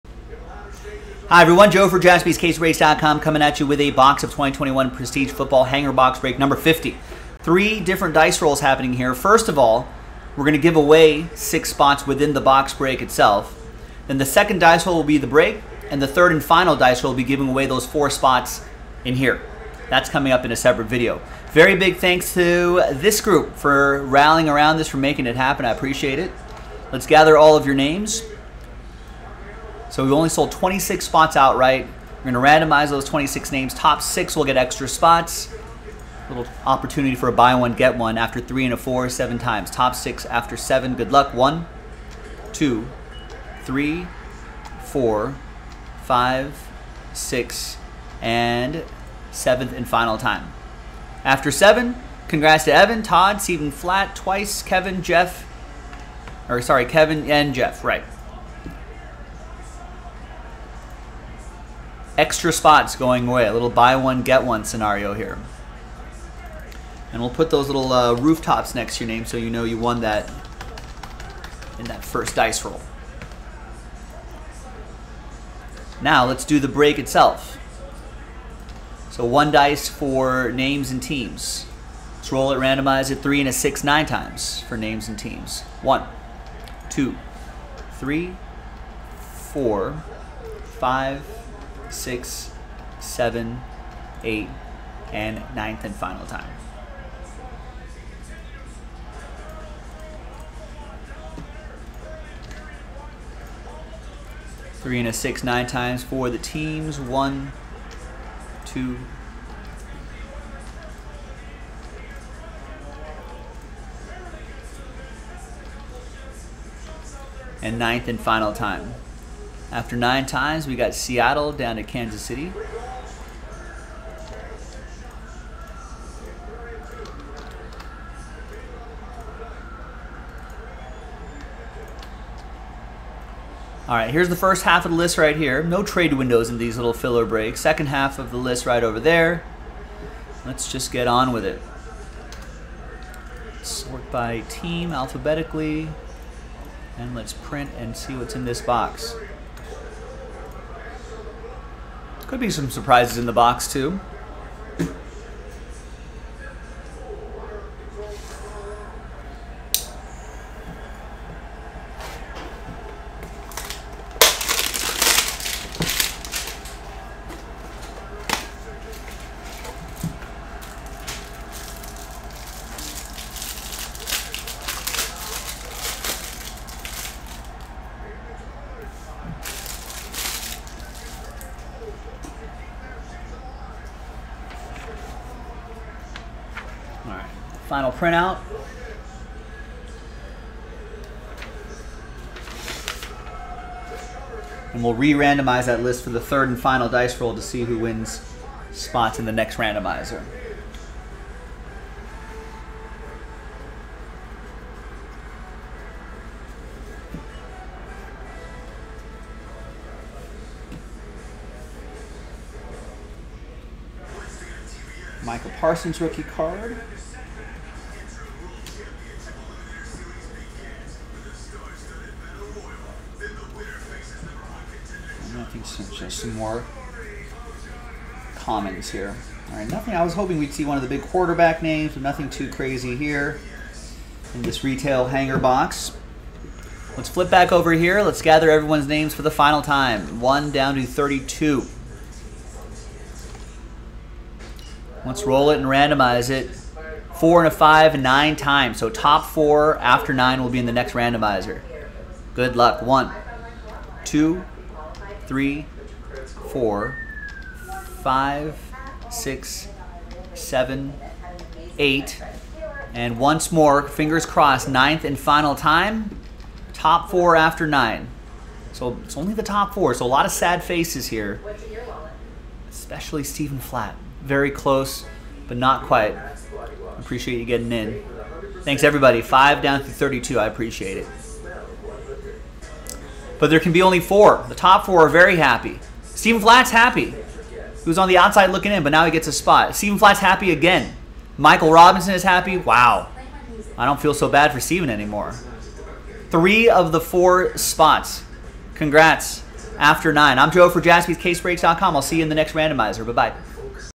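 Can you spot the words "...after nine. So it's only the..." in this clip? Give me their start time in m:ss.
4:27.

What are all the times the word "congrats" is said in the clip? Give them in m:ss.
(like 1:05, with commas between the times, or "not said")
0:52, 4:58.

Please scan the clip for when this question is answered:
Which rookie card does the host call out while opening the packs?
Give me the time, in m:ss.
3:35.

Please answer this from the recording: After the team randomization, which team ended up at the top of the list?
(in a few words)
Seattle.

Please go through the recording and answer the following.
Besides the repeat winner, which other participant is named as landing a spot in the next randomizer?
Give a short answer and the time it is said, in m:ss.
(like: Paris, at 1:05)
Michael Robinson, at 4:51.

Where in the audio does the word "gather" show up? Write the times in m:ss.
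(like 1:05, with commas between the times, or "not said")
0:27, 3:58.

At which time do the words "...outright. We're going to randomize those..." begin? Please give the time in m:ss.
0:31.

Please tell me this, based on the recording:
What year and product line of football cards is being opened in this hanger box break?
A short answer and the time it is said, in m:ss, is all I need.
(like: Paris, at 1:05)
2021 Prestige, at 0:04.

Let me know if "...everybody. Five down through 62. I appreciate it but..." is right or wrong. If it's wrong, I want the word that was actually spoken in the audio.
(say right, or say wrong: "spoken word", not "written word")
wrong: "32", not "62".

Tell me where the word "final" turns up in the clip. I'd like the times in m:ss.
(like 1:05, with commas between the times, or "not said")
0:16, 0:49, 1:35, 1:58, 3:07, 3:16, 3:59, 4:25.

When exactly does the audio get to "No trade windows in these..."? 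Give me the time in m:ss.
2:15.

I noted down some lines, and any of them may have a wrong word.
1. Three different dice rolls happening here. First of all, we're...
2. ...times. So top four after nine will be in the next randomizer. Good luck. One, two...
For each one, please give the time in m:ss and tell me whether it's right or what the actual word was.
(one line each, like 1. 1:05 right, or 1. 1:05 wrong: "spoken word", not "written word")
1. 0:07 right
2. 4:08 right.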